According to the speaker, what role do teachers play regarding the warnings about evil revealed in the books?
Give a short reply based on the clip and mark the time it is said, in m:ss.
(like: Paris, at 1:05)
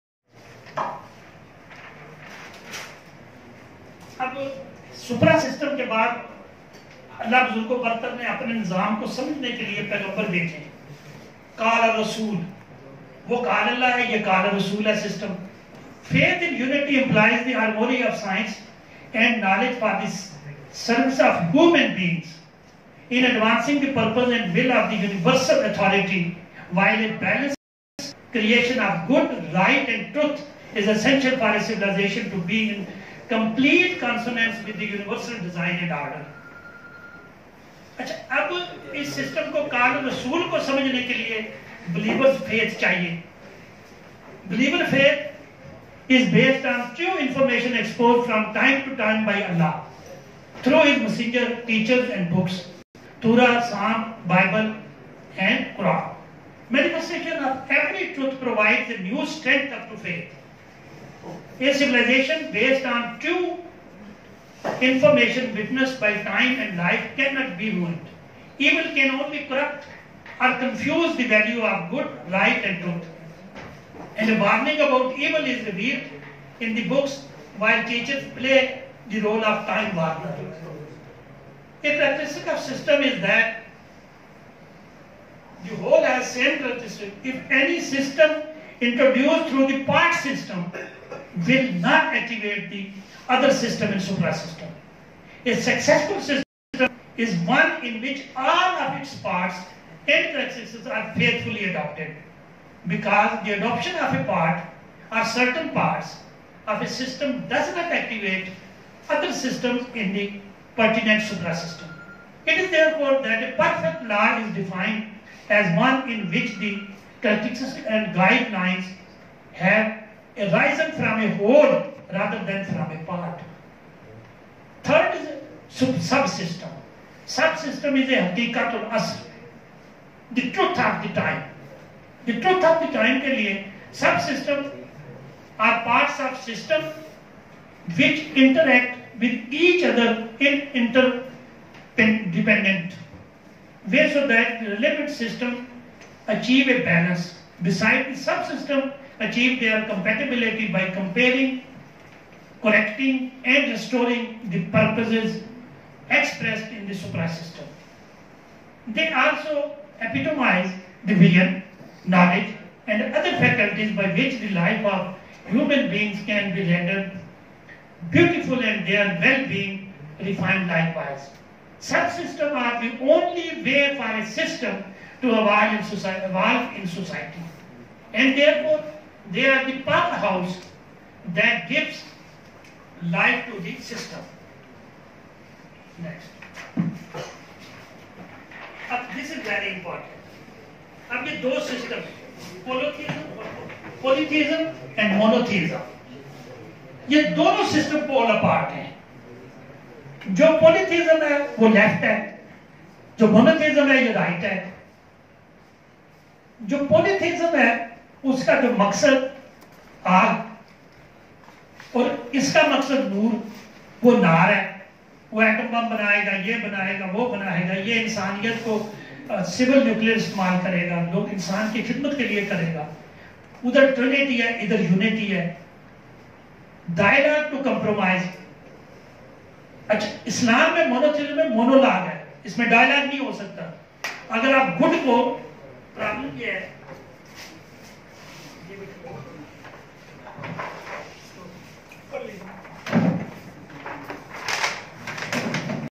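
time warner, at 1:19.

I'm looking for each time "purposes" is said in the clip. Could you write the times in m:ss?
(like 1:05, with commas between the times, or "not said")
2:34.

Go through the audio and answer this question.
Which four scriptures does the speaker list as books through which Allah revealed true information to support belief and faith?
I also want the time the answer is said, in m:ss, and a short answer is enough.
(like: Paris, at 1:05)
Torah, Psalm, Bible and Quran, at 0:53.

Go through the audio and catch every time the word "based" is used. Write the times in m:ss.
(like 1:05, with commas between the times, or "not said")
0:46, 1:02.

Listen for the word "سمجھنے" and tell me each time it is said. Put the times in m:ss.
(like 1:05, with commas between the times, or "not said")
0:09, 0:40.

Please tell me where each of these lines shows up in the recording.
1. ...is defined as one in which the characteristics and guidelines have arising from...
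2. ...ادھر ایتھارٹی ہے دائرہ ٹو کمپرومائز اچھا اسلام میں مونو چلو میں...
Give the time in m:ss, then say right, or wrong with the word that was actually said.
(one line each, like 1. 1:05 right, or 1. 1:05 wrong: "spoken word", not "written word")
1. 1:54 right
2. 3:44 wrong: "یونیٹی", not "ایتھارٹی".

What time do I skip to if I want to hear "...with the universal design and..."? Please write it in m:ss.
0:34.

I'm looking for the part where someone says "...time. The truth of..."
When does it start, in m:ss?
2:11.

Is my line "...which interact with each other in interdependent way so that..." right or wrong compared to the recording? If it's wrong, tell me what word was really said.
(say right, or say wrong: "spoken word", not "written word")
right.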